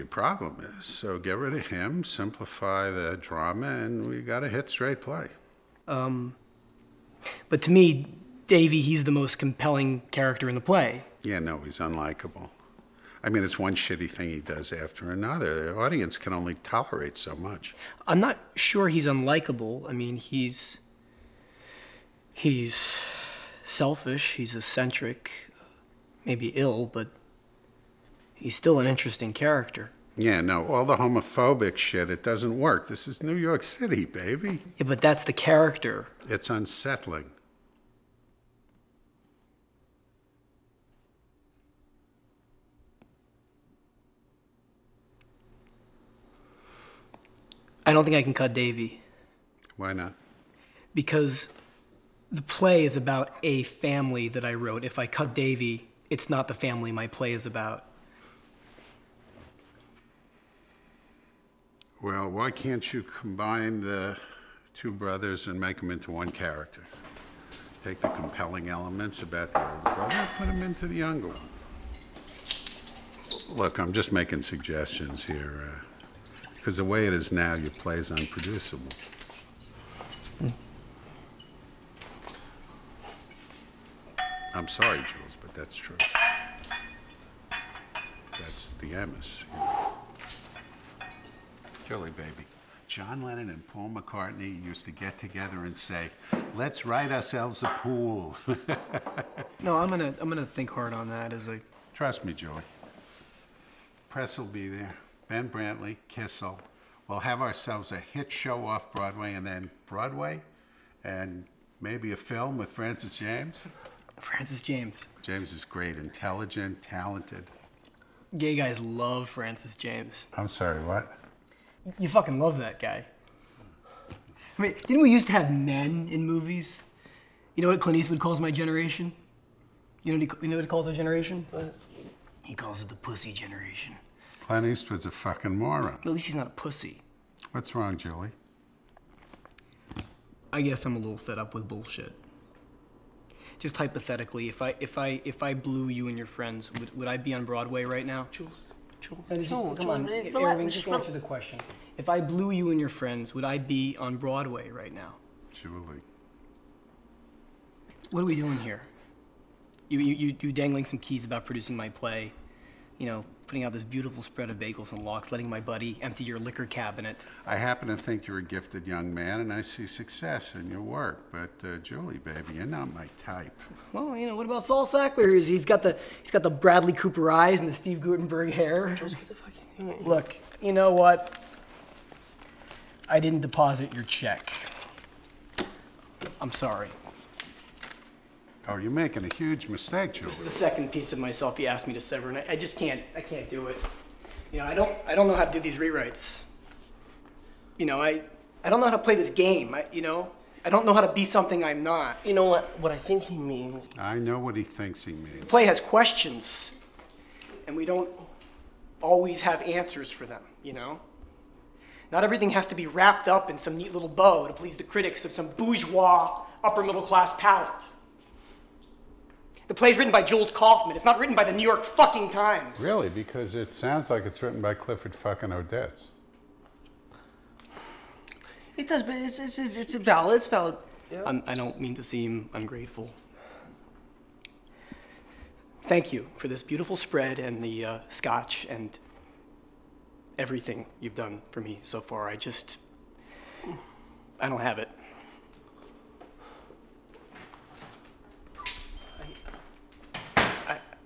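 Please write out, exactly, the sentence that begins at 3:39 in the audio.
The play's written by Jules Kaufman.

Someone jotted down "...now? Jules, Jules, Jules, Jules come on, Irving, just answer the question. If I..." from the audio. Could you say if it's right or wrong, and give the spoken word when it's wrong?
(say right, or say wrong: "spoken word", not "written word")
right.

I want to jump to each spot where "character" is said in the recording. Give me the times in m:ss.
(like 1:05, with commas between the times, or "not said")
0:10, 0:29, 0:35, 1:06.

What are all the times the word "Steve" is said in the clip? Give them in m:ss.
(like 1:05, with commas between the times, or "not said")
2:57.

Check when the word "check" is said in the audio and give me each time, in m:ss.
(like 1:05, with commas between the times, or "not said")
3:04.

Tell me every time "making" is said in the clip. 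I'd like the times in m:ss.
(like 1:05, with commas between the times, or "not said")
1:14, 3:08.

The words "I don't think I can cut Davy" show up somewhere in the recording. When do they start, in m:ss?
0:47.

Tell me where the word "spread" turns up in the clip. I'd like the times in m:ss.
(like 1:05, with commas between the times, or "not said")
2:44, 3:56.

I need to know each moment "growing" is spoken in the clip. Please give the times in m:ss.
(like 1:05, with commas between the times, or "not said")
not said.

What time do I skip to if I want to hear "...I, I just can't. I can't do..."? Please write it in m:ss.
3:12.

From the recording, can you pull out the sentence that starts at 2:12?
He calls it the pussy generation.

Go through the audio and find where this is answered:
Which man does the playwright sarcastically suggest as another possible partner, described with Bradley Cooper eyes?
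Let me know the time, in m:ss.
2:54.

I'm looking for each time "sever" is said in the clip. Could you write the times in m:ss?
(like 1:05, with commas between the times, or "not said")
3:12.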